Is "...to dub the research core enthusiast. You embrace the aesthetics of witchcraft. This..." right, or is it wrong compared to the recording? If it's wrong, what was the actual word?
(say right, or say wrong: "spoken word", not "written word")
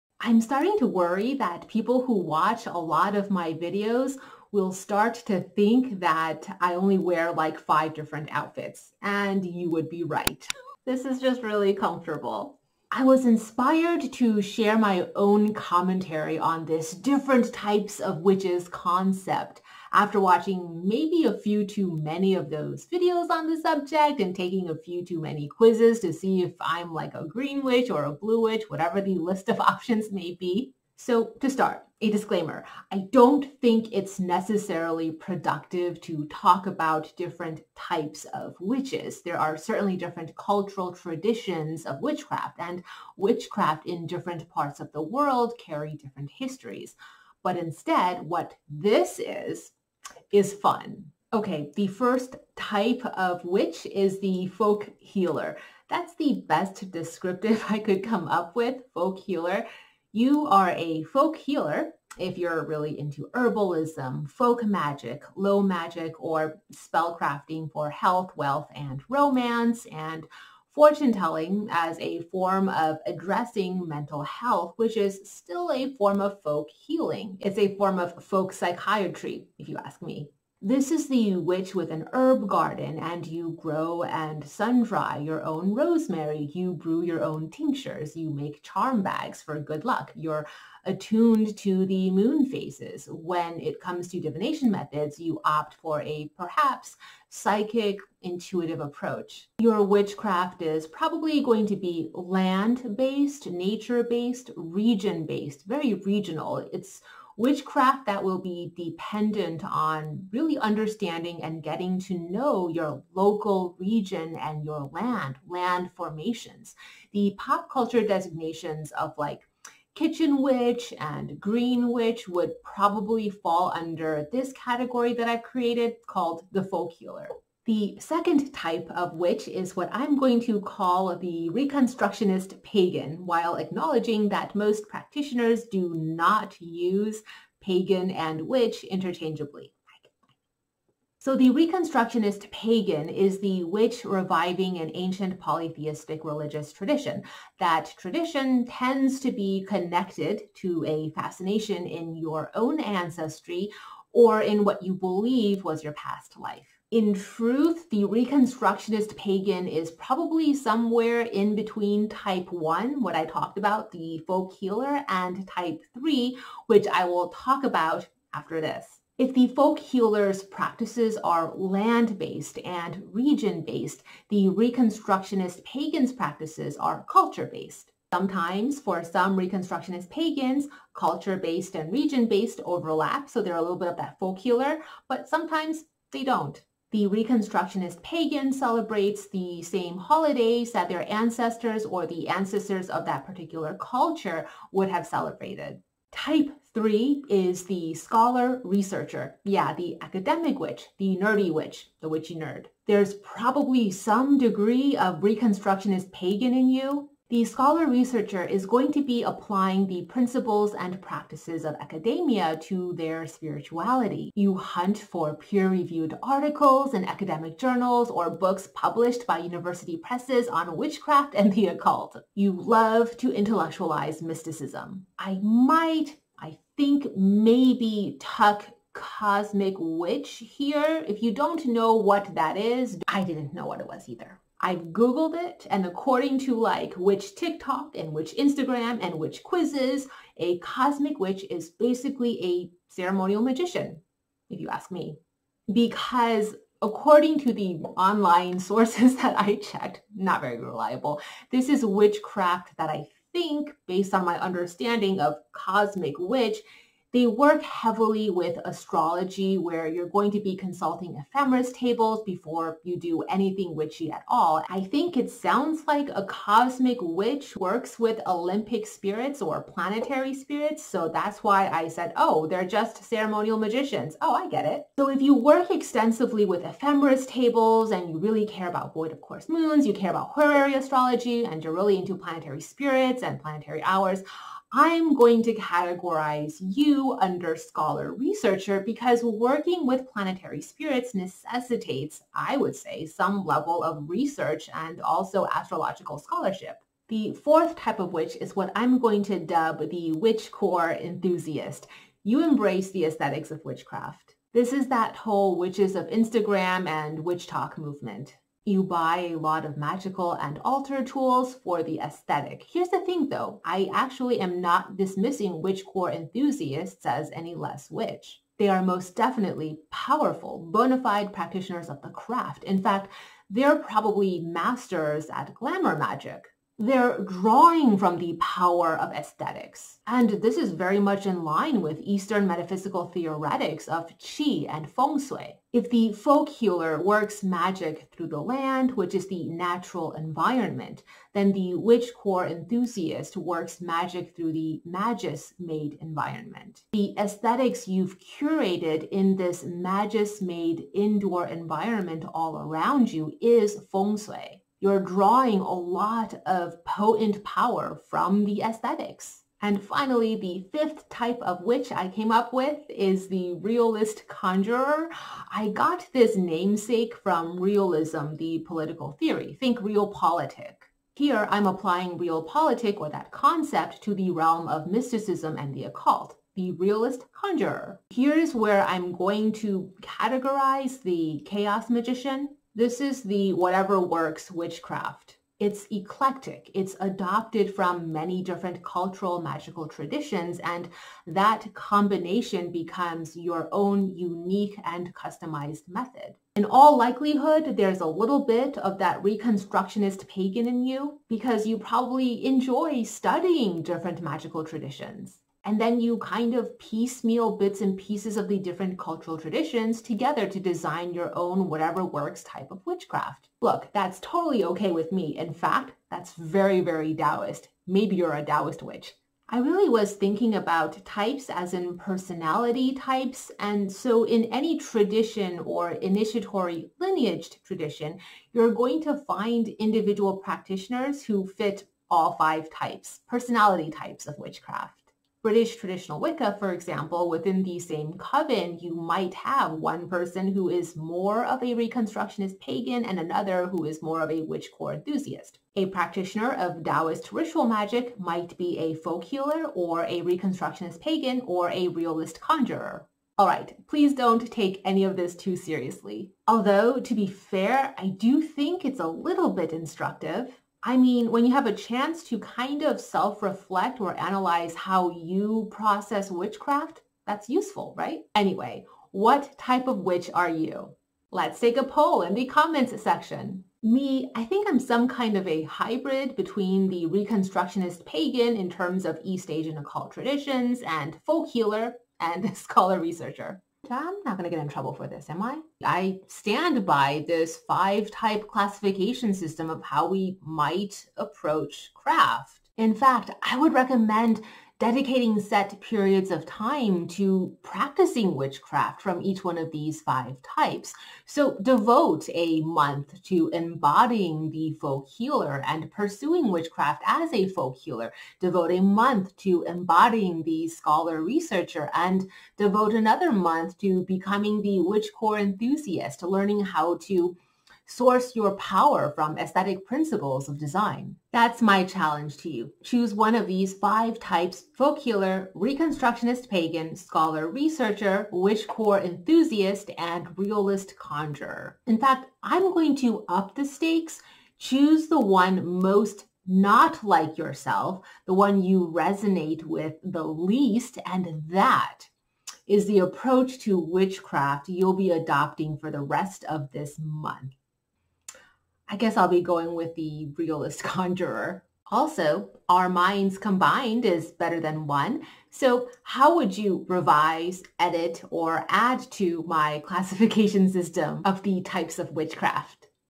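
wrong: "witch", not "research".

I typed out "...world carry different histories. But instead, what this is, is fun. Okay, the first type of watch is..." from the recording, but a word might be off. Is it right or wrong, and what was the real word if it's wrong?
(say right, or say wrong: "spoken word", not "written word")
wrong: "witch", not "watch".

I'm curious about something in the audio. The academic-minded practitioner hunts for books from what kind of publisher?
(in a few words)
University presses.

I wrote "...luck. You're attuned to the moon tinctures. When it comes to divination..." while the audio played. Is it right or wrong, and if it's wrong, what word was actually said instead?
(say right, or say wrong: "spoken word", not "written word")
wrong: "phases", not "tinctures".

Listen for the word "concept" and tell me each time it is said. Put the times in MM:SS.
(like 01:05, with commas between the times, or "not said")
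00:18, 06:13.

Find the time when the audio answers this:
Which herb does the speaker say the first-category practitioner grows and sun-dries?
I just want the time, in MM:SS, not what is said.
01:25.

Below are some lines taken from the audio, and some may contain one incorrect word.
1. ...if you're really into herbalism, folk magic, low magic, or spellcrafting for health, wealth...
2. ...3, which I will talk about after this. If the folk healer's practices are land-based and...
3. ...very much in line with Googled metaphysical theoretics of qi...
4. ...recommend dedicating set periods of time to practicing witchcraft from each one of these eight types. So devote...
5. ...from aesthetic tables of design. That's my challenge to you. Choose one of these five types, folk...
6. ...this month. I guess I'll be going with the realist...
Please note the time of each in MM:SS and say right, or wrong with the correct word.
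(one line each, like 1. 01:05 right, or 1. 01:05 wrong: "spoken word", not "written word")
1. 01:02 right
2. 02:45 right
3. 05:30 wrong: "Eastern", not "Googled"
4. 08:13 wrong: "five", not "eight"
5. 08:39 wrong: "principles", not "tables"
6. 09:06 right.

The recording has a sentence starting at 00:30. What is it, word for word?
So to start, a disclaimer, I don't think it's necessarily productive to talk about different types of witches.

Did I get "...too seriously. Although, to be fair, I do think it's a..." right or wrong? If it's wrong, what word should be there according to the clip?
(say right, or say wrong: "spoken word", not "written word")
right.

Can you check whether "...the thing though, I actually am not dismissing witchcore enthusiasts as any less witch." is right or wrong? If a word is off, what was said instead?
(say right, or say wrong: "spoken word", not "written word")
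right.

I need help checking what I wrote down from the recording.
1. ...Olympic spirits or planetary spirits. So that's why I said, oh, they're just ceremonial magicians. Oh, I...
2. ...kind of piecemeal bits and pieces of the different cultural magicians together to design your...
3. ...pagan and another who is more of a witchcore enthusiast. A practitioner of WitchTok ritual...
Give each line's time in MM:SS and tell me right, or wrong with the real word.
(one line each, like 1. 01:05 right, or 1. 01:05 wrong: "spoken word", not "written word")
1. 04:28 right
2. 06:46 wrong: "traditions", not "magicians"
3. 07:22 wrong: "Taoist", not "WitchTok".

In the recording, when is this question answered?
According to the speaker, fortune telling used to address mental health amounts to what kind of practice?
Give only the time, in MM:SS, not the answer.
01:18.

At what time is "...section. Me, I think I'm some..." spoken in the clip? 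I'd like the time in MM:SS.
07:53.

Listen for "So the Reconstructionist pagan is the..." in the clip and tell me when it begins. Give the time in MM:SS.
02:21.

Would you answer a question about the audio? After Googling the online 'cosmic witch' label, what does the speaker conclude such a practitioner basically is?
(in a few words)
A ceremonial magician.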